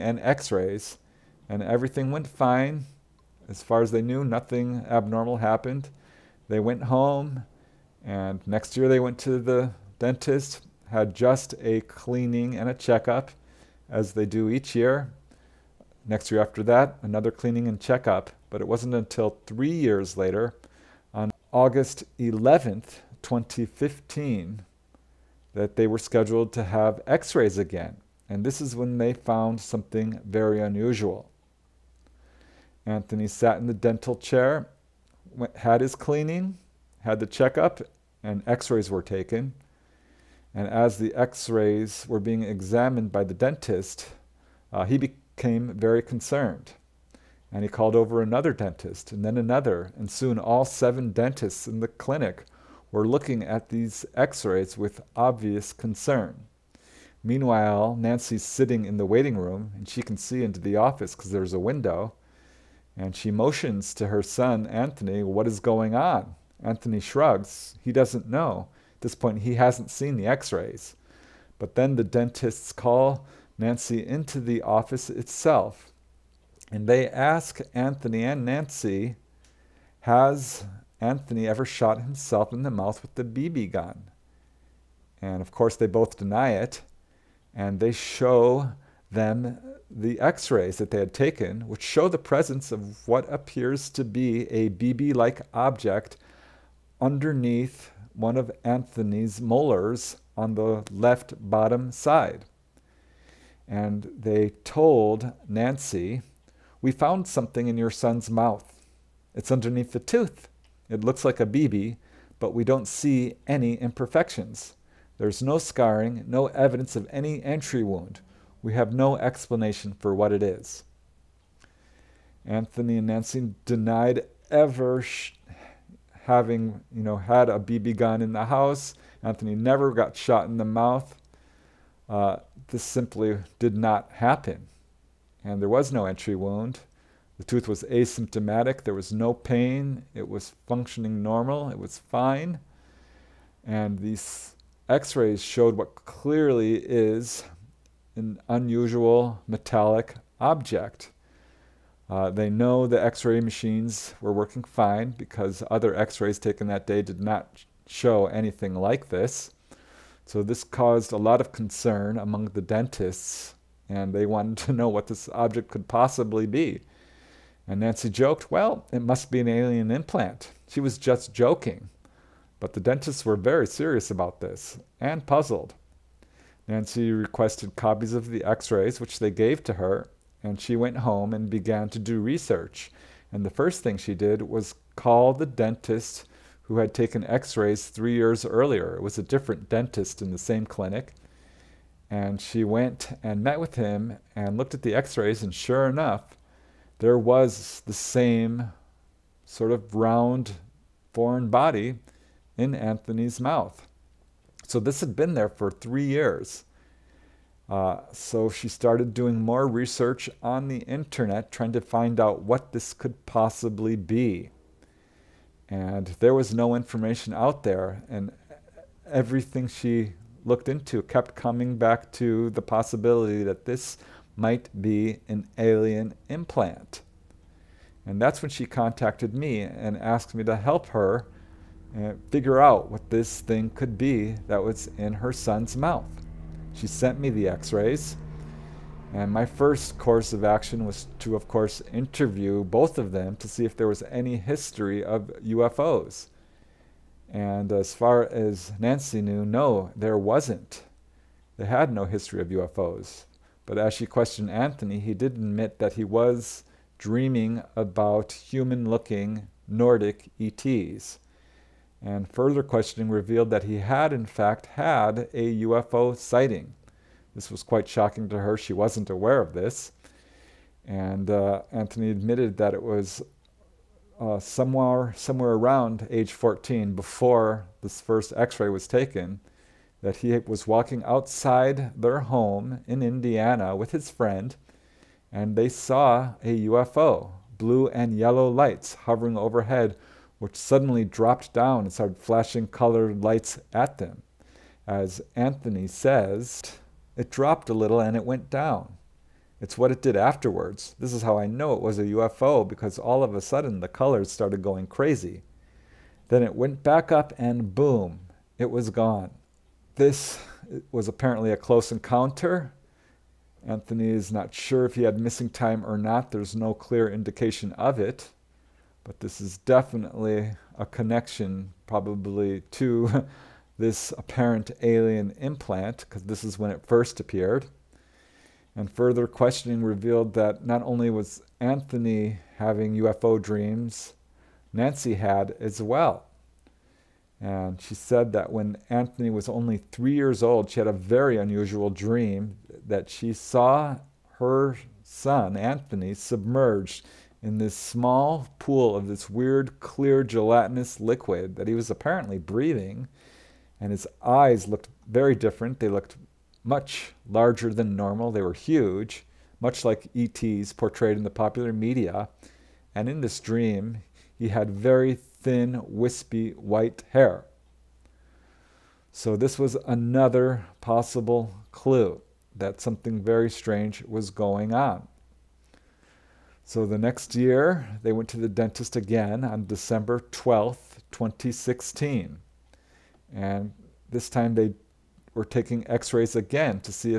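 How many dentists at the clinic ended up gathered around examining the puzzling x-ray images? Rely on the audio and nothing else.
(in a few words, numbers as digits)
7.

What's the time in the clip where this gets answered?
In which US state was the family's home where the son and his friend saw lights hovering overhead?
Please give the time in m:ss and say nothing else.
4:43.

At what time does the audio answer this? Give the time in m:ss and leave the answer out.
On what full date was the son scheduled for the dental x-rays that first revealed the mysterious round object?
0:21.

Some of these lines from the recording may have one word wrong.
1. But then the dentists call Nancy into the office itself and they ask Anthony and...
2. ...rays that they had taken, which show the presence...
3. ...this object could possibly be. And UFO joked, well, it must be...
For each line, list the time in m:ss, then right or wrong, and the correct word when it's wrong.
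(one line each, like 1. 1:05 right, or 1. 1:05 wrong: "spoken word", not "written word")
1. 1:11 right
2. 1:30 right
3. 2:45 wrong: "Nancy", not "UFO".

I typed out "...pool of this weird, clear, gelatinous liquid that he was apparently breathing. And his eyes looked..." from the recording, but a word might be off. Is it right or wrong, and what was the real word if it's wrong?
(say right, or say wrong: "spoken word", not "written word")
right.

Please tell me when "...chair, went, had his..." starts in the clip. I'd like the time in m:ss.
0:34.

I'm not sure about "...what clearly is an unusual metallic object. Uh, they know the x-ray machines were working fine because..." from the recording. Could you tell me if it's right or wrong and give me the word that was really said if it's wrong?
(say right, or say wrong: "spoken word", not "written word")
right.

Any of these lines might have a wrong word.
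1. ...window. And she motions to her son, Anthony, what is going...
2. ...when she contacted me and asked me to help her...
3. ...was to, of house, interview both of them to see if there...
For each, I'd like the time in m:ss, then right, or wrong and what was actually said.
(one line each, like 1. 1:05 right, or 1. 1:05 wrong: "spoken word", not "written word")
1. 1:01 right
2. 3:48 right
3. 4:00 wrong: "course", not "house".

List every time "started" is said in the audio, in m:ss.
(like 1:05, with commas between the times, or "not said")
3:28, 4:51, 5:04.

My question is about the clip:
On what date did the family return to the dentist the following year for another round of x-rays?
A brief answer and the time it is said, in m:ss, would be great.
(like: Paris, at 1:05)
December 12th, 2016, at 6:19.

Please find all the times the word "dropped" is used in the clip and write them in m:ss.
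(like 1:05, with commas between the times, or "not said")
4:51, 4:57.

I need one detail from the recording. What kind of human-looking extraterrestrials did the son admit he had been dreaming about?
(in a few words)
Nordic ETs.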